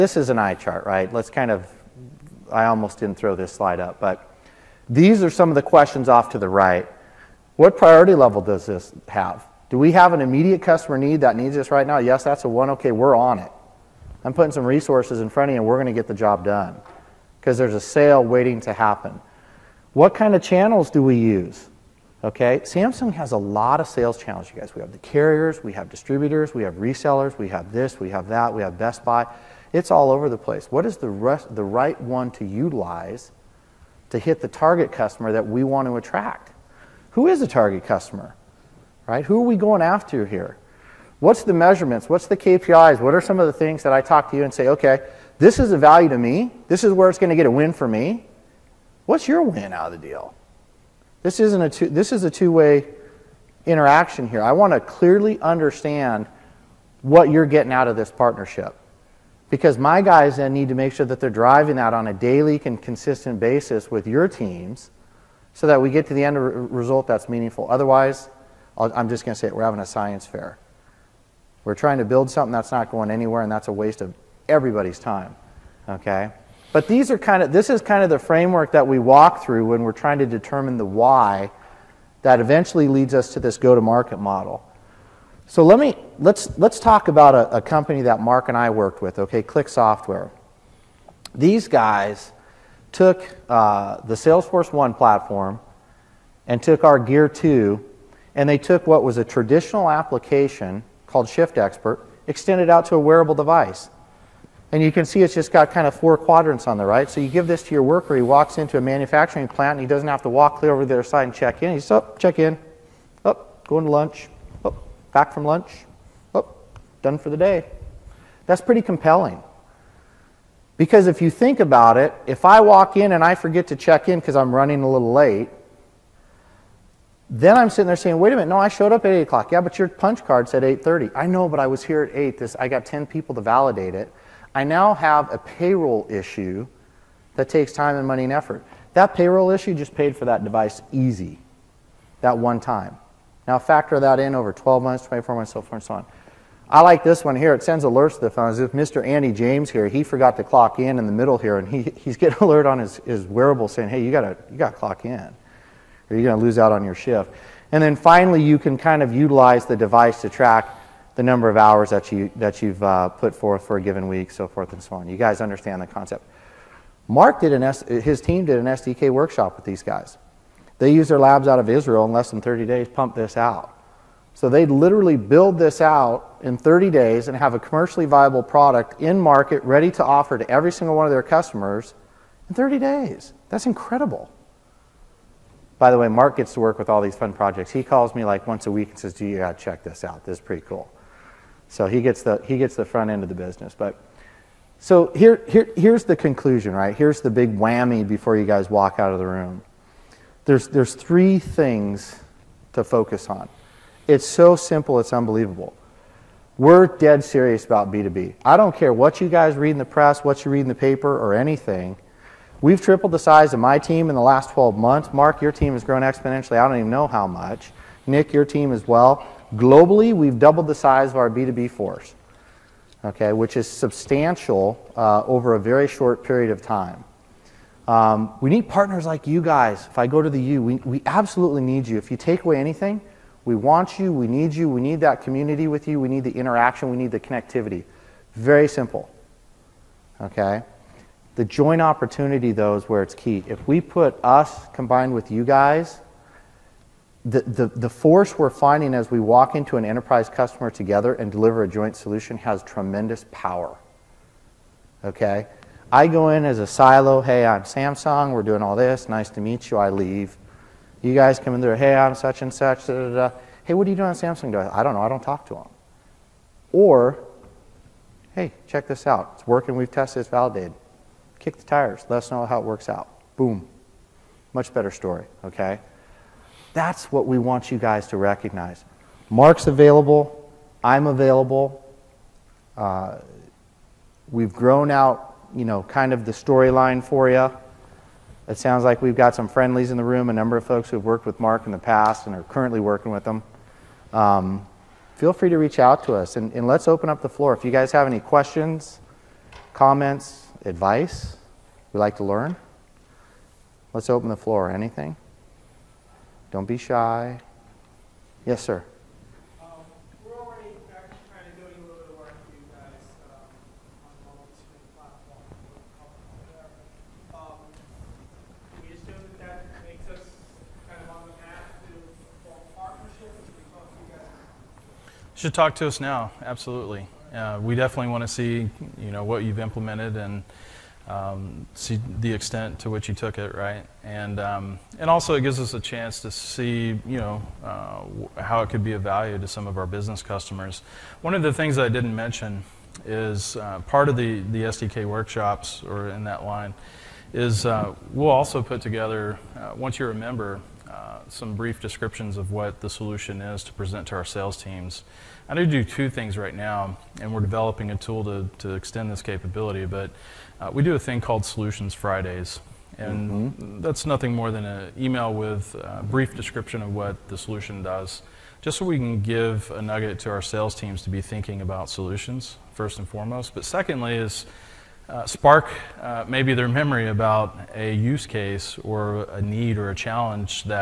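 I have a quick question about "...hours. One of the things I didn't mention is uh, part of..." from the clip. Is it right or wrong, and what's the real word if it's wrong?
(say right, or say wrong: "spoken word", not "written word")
wrong: "customers", not "hours".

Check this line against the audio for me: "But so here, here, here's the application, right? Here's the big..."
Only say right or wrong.
wrong.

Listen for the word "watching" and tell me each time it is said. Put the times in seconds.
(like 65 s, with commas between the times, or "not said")
not said.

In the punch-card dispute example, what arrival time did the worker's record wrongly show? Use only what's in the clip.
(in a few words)
8:30.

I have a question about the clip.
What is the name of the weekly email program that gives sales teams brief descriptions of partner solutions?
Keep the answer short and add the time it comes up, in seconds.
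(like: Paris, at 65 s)
Solutions Fridays, at 361 s.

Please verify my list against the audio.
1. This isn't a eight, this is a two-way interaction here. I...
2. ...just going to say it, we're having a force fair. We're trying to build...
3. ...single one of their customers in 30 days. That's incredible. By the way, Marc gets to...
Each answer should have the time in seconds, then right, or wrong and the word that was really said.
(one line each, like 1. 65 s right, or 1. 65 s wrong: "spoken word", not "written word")
1. 51 s wrong: "two", not "eight"
2. 69 s wrong: "science", not "force"
3. 180 s right.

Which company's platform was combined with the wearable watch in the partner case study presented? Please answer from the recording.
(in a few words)
Salesforce One.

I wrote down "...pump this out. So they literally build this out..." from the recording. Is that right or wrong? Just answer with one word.
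right.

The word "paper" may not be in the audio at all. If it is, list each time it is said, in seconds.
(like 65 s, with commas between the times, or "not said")
210 s.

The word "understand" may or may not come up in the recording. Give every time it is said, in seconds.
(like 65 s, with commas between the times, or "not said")
55 s, 165 s.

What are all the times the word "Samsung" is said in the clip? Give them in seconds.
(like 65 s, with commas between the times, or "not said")
22 s, 257 s, 264 s.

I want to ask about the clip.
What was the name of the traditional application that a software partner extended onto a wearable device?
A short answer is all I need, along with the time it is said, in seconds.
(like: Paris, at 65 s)
Shift Expert, at 101 s.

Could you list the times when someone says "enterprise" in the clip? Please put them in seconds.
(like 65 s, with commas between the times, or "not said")
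249 s.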